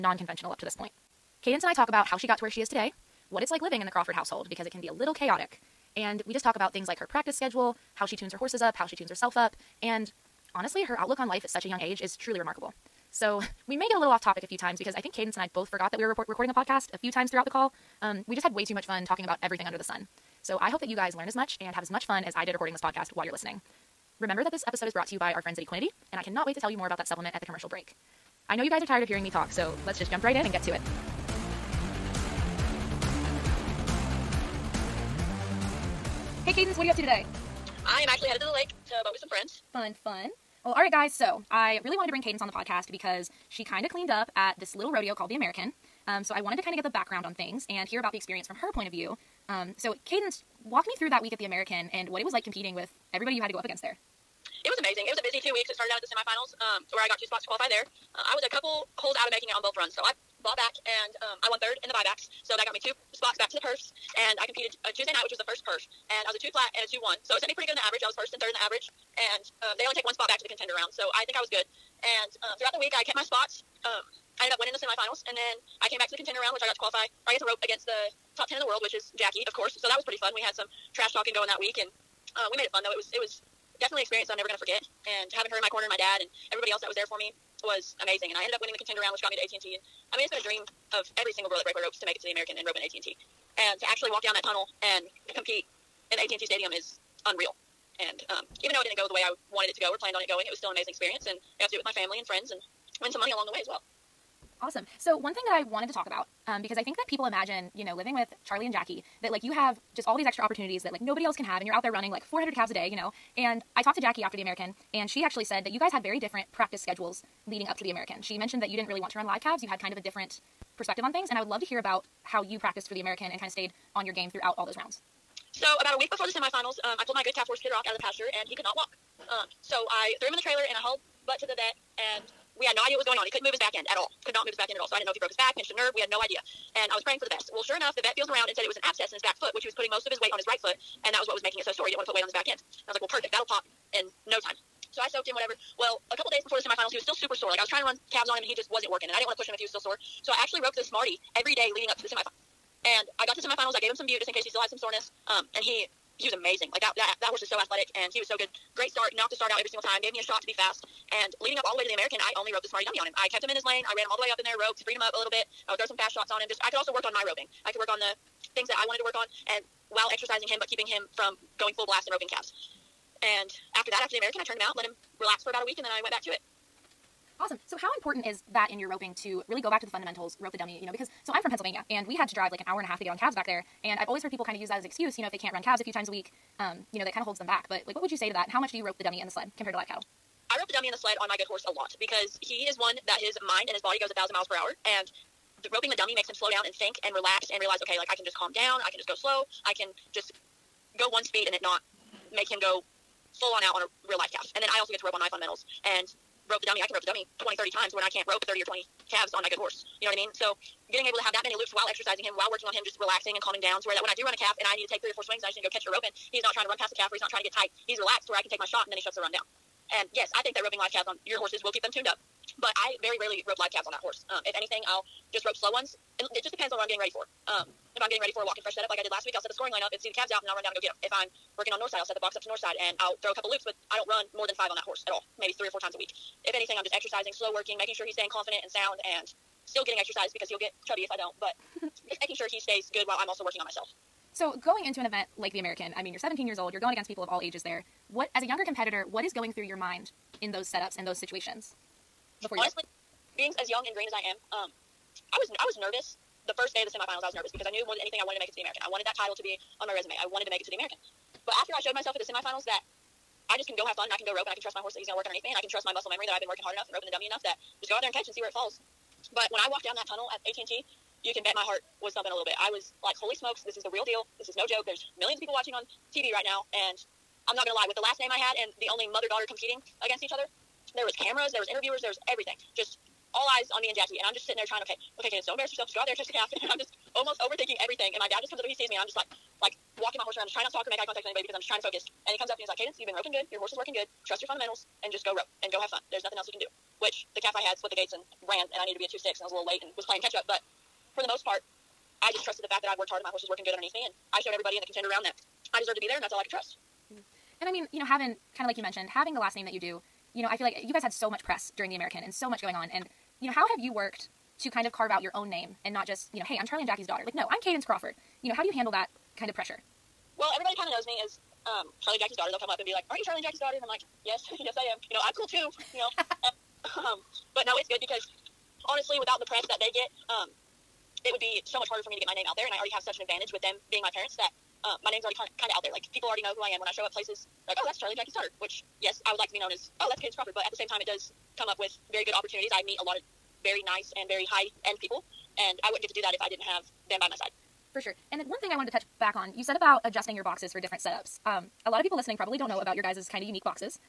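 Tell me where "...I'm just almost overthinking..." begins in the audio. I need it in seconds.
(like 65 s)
286 s.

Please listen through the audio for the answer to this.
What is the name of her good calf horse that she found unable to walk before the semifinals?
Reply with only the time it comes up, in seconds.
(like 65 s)
127 s.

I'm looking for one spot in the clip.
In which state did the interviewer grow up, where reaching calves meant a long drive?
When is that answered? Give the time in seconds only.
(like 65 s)
181 s.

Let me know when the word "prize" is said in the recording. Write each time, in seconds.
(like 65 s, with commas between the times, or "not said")
not said.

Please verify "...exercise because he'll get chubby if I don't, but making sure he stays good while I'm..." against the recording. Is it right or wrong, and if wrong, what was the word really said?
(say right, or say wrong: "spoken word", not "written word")
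right.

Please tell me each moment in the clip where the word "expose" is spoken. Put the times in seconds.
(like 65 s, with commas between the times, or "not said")
not said.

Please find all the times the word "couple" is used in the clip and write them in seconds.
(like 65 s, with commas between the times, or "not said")
58 s, 146 s, 233 s.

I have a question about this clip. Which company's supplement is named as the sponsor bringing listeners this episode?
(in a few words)
Equinety.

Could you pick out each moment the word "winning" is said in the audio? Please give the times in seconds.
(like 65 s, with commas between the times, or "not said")
74 s, 88 s.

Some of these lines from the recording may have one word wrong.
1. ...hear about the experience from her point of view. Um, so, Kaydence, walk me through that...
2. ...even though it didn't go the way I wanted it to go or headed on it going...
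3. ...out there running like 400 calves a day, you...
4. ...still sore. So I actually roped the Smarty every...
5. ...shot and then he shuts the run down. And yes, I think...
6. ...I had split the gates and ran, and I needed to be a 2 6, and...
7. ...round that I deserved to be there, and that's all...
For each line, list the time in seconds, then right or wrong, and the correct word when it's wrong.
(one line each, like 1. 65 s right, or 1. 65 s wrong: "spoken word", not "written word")
1. 47 s right
2. 98 s wrong: "planned", not "headed"
3. 111 s right
4. 149 s right
5. 218 s right
6. 297 s right
7. 305 s right.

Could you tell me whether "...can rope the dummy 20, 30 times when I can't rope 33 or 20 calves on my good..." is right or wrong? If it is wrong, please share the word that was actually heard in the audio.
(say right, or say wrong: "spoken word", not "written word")
wrong: "30", not "33".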